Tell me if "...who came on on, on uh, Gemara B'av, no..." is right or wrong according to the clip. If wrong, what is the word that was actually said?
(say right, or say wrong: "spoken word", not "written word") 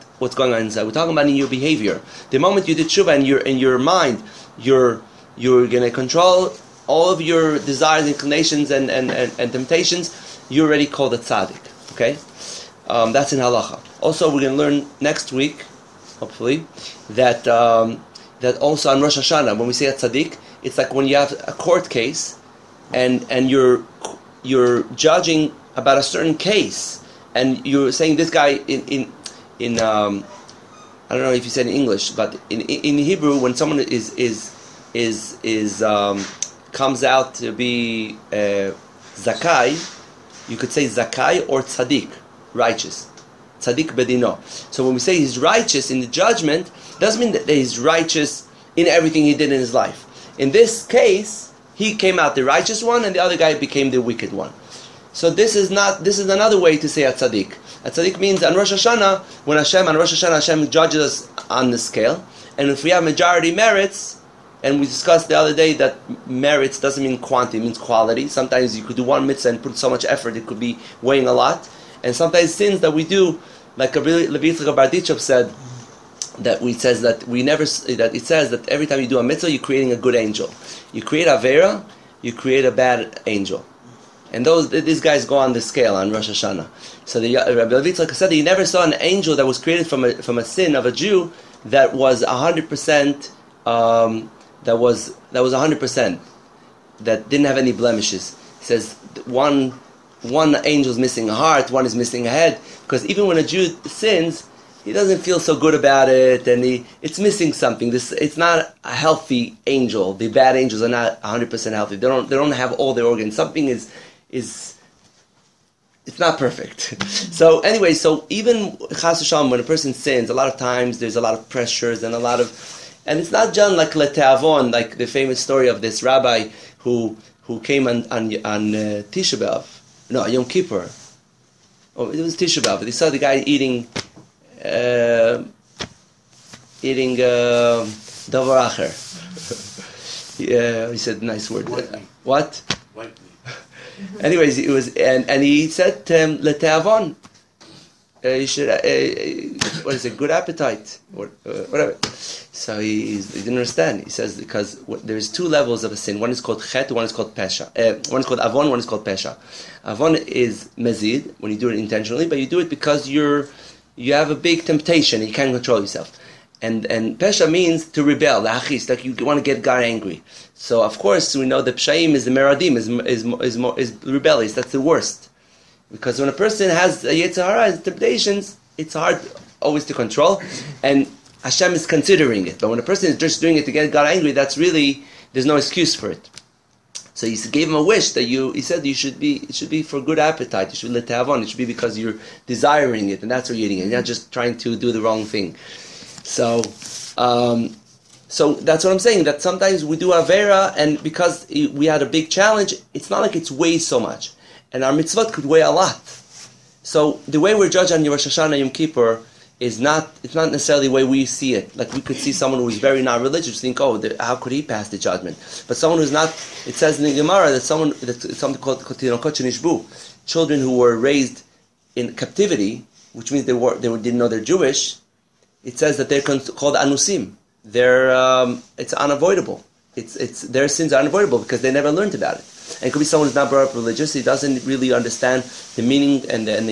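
wrong: "Tisha", not "Gemara".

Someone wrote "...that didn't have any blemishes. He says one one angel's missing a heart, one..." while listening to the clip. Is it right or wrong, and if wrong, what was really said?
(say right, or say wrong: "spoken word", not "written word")
right.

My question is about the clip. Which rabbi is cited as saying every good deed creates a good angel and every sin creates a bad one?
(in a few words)
Levi Yitzchak Berditchev.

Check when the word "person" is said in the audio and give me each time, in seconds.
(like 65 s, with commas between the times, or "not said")
119 s, 176 s, 182 s.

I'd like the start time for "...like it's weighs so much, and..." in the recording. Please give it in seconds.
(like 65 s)
203 s.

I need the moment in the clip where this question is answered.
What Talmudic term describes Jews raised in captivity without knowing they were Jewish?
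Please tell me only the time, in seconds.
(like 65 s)
218 s.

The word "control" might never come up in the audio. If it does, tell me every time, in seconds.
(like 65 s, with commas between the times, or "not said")
5 s, 165 s, 179 s.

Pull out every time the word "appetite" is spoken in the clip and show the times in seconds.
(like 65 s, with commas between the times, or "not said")
150 s, 190 s.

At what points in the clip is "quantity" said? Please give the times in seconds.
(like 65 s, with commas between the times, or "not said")
67 s.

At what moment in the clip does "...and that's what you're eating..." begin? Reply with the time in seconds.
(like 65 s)
193 s.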